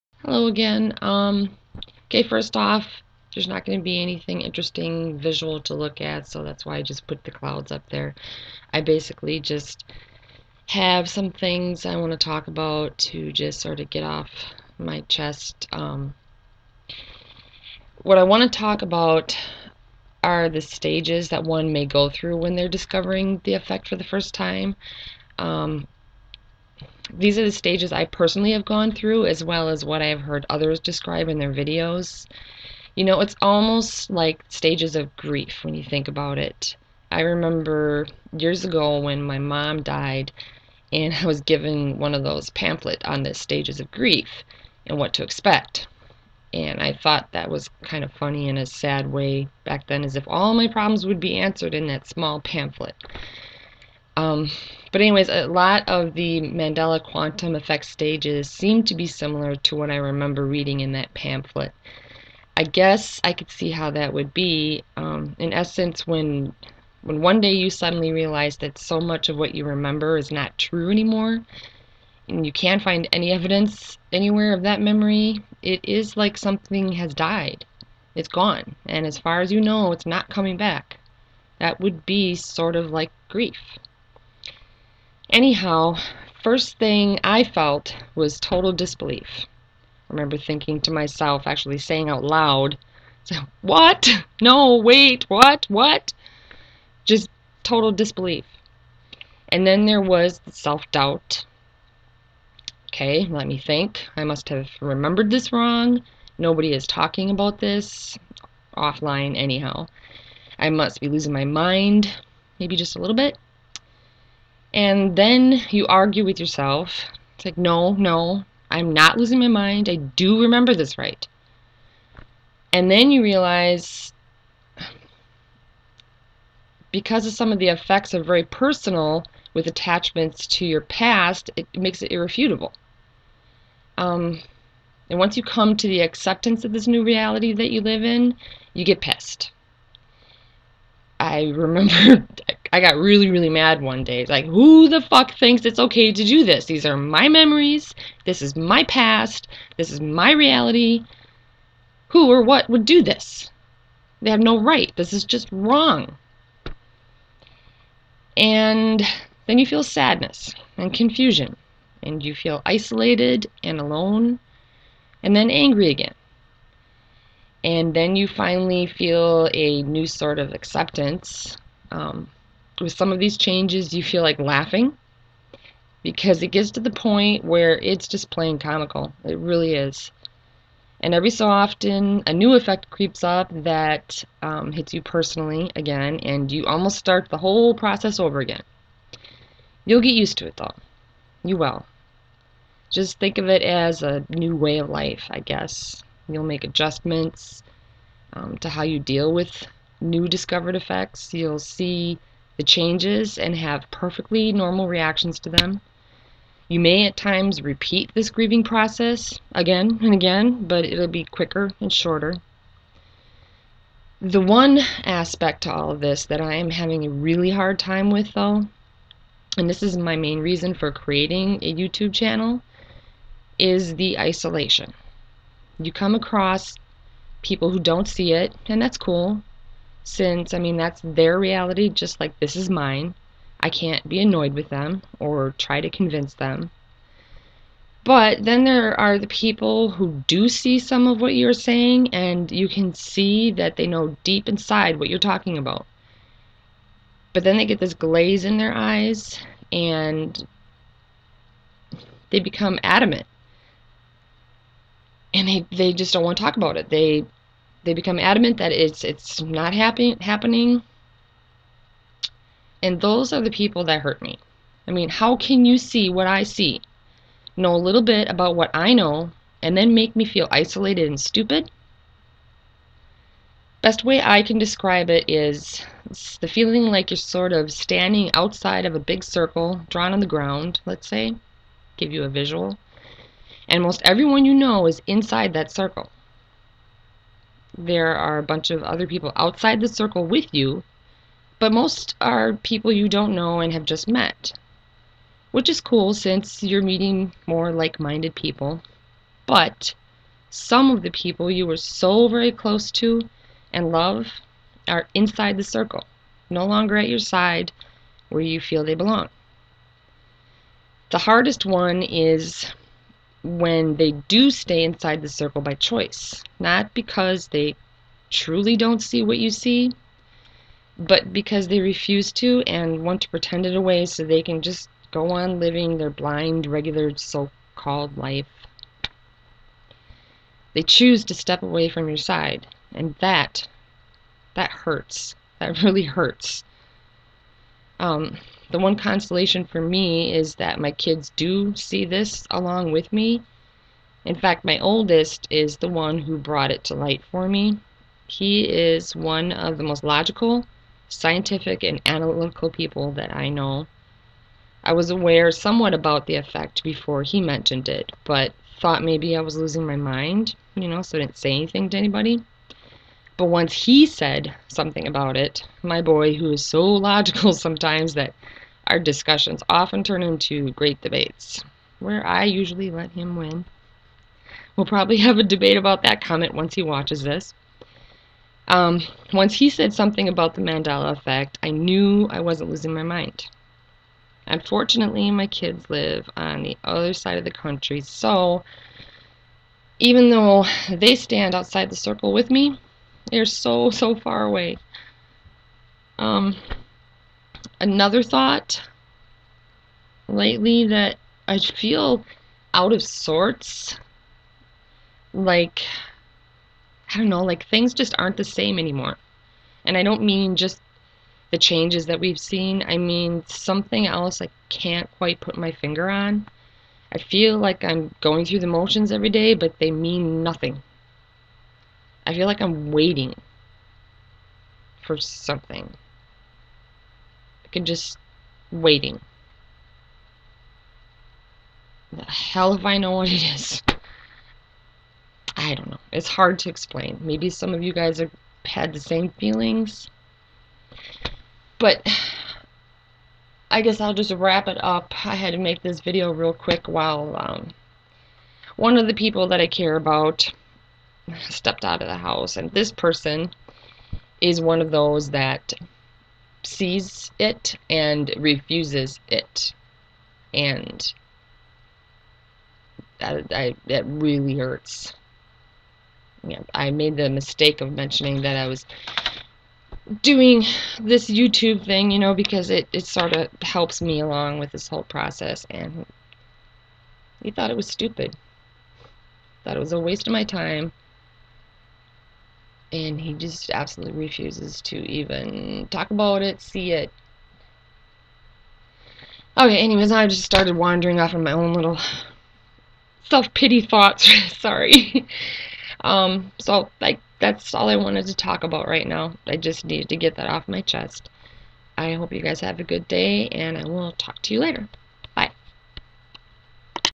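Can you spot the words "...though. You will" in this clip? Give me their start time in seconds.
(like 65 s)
190 s.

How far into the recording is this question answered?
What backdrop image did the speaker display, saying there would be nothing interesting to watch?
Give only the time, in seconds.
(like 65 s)
7 s.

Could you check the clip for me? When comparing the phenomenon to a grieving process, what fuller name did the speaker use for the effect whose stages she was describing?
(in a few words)
Mandela quantum effect.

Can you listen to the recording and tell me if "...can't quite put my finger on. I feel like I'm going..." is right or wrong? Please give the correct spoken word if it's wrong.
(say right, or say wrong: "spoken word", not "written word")
right.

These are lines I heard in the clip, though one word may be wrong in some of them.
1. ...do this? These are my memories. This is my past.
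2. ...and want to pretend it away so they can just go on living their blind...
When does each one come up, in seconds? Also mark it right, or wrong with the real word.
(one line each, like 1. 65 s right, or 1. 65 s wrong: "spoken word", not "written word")
1. 146 s right
2. 322 s right.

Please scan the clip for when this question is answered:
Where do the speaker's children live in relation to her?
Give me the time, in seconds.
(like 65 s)
386 s.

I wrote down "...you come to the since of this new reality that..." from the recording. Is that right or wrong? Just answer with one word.
wrong.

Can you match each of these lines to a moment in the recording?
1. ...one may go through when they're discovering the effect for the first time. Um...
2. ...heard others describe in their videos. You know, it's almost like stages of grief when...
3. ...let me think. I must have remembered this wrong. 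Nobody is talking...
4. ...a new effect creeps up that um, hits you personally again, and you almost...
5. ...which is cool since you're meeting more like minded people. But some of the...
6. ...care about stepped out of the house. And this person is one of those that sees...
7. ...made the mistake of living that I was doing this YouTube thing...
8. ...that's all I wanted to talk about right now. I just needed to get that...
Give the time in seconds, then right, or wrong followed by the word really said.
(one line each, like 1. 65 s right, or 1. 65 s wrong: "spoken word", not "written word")
1. 21 s right
2. 30 s right
3. 103 s right
4. 182 s right
5. 295 s right
6. 449 s right
7. 466 s wrong: "mentioning", not "living"
8. 497 s right.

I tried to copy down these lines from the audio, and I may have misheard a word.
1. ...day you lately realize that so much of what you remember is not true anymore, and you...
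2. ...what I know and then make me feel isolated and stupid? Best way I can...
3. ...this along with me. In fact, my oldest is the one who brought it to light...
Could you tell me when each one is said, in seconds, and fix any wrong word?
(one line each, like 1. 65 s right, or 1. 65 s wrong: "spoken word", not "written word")
1. 67 s wrong: "suddenly", not "lately"
2. 268 s right
3. 342 s right.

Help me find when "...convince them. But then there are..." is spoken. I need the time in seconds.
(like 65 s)
235 s.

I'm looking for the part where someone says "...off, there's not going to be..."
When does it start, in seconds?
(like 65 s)
2 s.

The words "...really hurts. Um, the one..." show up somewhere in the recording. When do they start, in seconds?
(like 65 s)
335 s.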